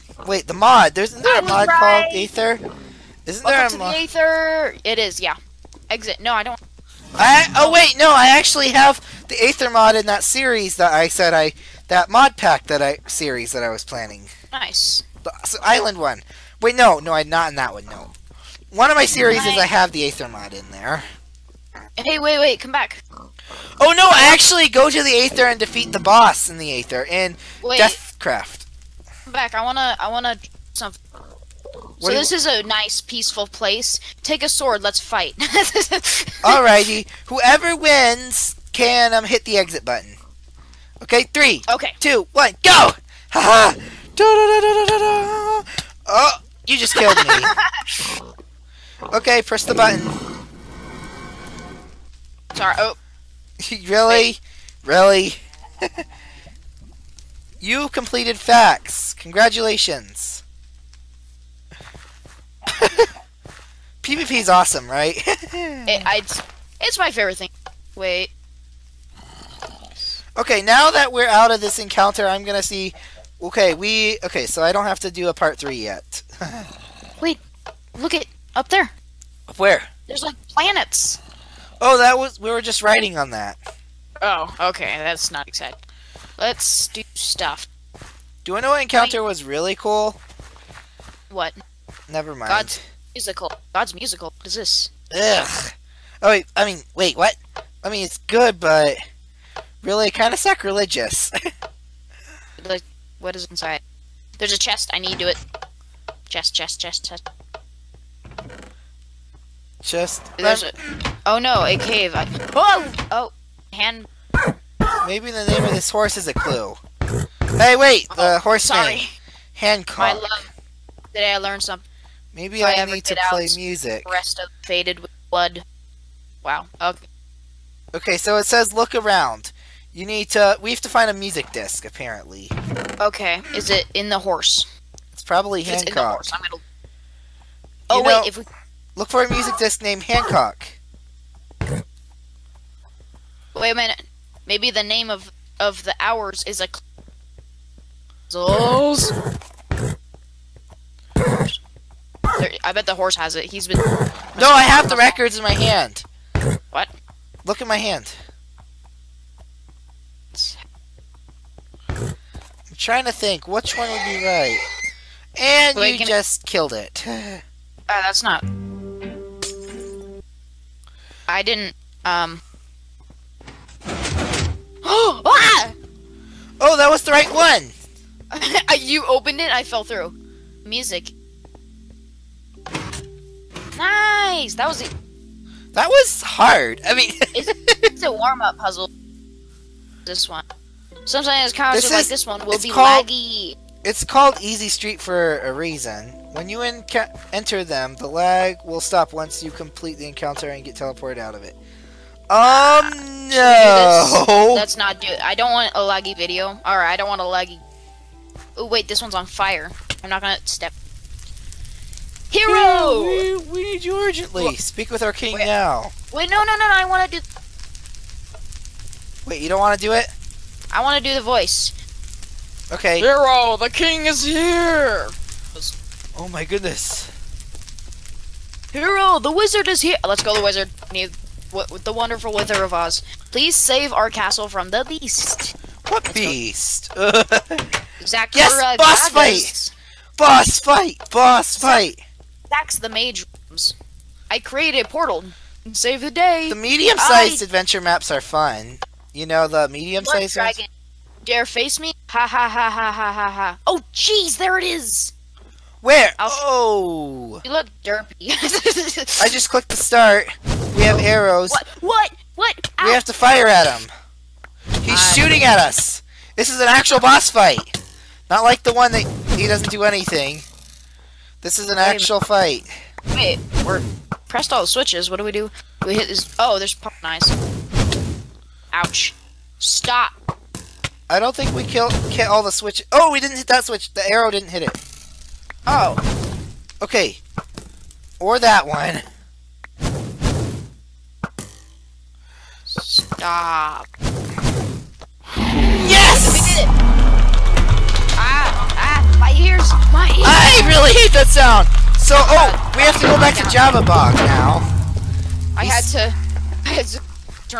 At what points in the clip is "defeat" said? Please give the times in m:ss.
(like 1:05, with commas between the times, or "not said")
0:25.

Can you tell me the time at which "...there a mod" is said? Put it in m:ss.
0:03.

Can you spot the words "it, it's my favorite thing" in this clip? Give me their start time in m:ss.
1:05.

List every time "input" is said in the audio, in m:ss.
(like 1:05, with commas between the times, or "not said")
not said.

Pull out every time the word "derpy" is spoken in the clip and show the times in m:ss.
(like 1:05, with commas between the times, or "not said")
4:17.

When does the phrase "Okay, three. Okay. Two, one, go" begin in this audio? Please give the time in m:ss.
0:41.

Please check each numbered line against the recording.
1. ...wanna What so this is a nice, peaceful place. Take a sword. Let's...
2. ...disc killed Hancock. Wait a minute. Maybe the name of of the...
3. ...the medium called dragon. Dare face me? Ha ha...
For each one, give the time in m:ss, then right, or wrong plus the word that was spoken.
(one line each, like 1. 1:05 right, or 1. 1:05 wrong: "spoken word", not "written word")
1. 0:30 right
2. 2:19 wrong: "named", not "killed"
3. 4:09 wrong: "sized", not "called".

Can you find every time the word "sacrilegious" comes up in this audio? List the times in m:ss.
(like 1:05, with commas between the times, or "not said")
1:40.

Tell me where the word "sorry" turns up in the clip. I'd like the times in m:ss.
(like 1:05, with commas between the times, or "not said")
0:52, 1:58.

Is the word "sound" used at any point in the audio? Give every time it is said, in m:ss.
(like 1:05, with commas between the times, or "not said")
5:01.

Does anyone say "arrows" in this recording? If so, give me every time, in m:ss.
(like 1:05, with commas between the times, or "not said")
4:20, 4:44.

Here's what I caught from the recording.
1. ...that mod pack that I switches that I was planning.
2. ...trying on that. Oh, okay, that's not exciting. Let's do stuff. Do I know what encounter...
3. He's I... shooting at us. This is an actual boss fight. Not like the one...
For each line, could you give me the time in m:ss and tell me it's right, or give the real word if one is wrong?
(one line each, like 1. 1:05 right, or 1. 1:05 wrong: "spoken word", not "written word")
1. 0:11 wrong: "series", not "switches"
2. 1:22 wrong: "writing", not "trying"
3. 4:24 right.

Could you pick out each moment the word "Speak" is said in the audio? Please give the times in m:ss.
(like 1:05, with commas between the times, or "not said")
3:34.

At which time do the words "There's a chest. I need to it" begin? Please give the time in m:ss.
1:44.